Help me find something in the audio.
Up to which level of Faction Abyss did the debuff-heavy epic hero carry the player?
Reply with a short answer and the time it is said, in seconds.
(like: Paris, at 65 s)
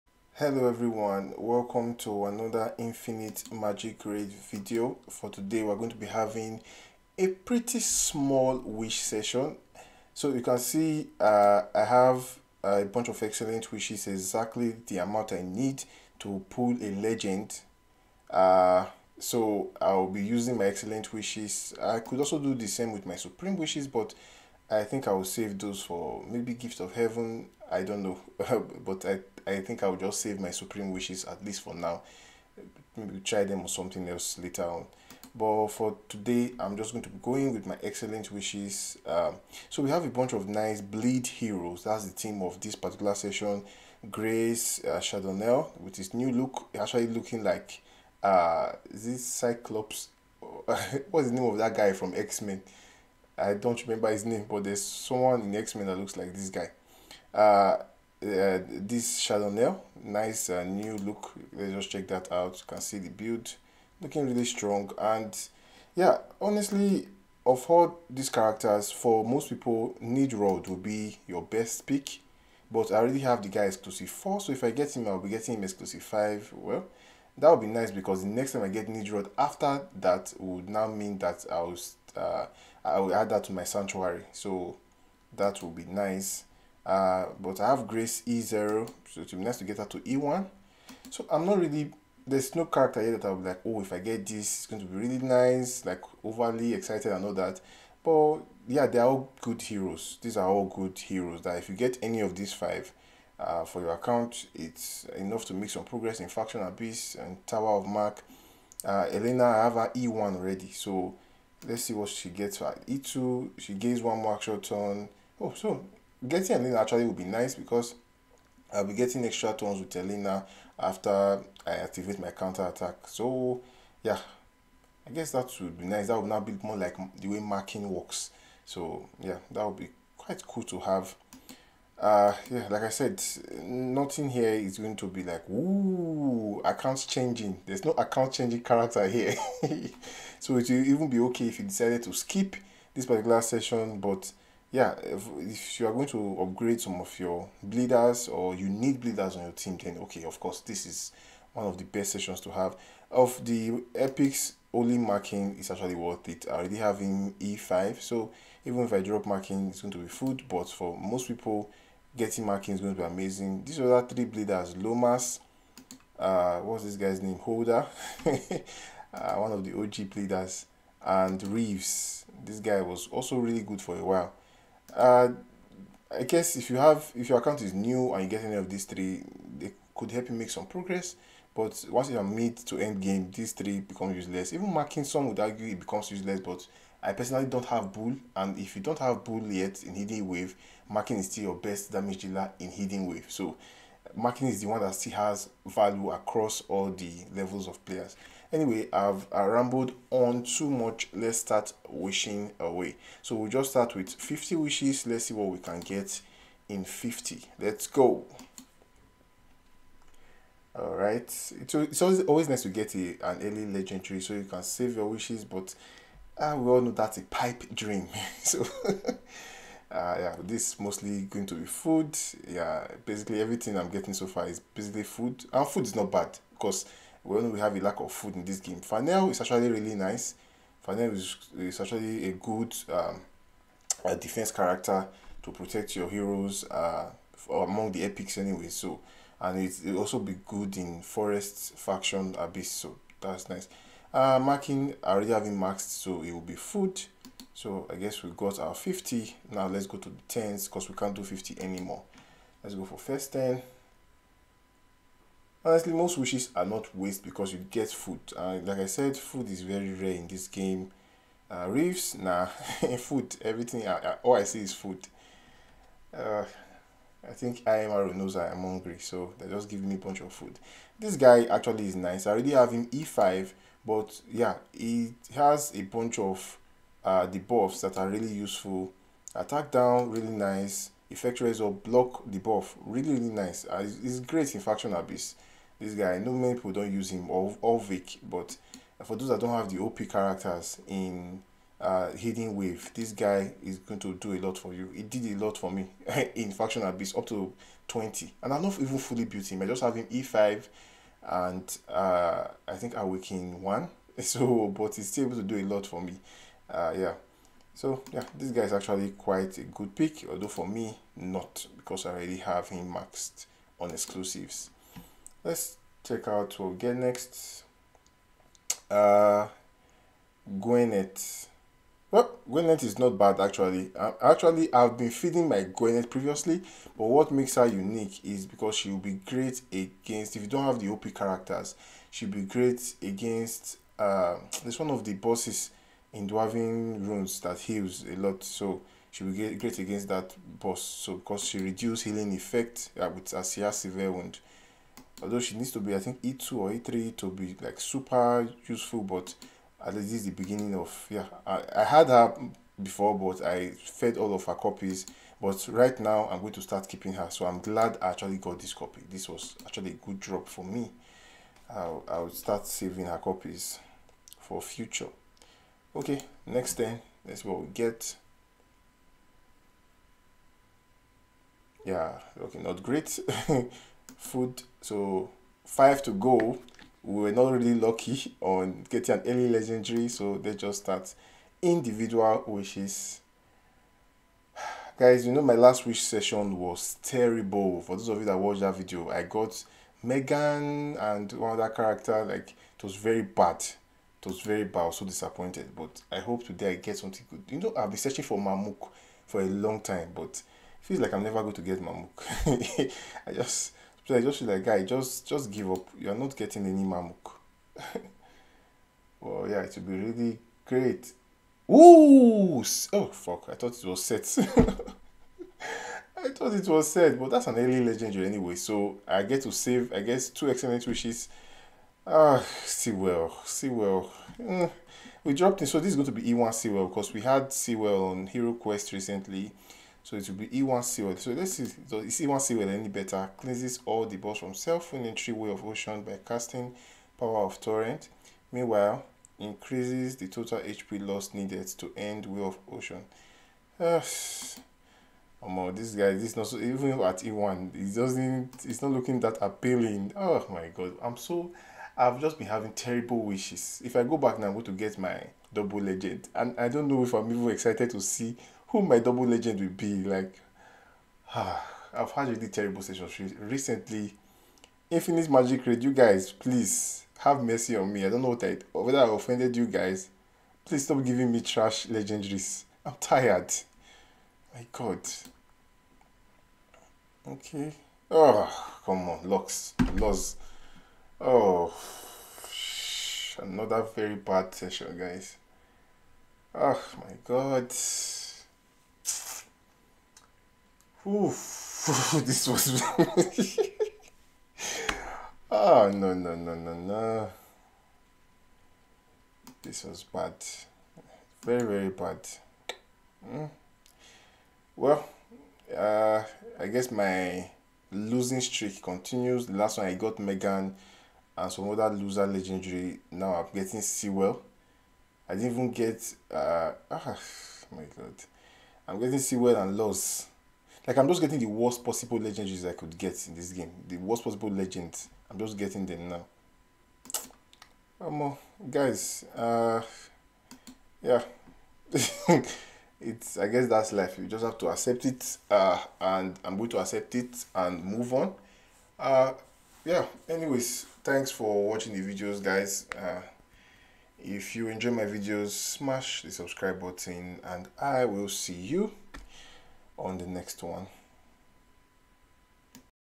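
20, at 297 s.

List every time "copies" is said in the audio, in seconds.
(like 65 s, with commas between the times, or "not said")
354 s, 363 s.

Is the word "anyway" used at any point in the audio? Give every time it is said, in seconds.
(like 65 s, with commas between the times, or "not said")
198 s, 238 s, 418 s, 540 s.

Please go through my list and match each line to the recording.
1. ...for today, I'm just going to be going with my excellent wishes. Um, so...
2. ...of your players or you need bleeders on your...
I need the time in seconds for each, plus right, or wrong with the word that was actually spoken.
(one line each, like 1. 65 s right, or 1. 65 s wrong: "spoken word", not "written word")
1. 35 s right
2. 147 s wrong: "bleeders", not "players".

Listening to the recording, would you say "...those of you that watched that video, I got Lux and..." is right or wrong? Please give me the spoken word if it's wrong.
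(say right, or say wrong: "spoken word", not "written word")
wrong: "Megan", not "Lux".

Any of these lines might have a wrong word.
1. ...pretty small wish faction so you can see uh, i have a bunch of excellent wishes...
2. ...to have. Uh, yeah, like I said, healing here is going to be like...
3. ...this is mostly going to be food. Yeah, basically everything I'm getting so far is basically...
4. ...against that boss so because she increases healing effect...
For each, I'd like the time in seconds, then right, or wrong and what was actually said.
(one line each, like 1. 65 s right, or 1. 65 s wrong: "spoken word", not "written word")
1. 7 s wrong: "session", not "faction"
2. 130 s wrong: "nothing", not "healing"
3. 220 s right
4. 339 s wrong: "reduces", not "increases".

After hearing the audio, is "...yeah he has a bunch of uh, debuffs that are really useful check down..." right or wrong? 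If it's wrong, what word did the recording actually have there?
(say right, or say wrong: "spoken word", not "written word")
wrong: "attack", not "check".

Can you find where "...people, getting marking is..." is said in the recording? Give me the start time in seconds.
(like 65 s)
161 s.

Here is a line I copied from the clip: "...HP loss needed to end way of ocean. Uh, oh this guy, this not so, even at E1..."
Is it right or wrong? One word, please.
right.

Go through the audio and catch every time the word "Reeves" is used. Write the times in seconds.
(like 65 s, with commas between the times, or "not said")
171 s.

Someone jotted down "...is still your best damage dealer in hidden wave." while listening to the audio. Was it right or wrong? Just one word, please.
right.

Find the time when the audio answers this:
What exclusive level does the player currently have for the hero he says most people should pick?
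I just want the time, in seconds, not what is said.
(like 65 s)
73 s.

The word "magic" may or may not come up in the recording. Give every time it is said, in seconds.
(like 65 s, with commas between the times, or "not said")
3 s, 465 s.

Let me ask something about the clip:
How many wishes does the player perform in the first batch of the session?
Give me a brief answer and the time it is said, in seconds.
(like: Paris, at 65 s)
50, at 204 s.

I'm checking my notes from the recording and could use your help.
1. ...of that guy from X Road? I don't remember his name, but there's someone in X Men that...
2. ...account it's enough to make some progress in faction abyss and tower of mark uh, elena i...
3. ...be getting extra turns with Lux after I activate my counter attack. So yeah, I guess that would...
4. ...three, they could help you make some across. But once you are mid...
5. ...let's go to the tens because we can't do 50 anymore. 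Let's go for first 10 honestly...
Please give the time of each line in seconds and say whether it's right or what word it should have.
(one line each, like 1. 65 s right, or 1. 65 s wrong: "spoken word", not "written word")
1. 51 s wrong: "Men", not "Road"
2. 103 s right
3. 118 s wrong: "Elena", not "Lux"
4. 178 s wrong: "progress", not "across"
5. 249 s right.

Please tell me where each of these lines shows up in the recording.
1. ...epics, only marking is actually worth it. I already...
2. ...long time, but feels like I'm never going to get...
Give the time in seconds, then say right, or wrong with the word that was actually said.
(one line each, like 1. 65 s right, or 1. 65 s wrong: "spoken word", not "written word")
1. 153 s right
2. 399 s right.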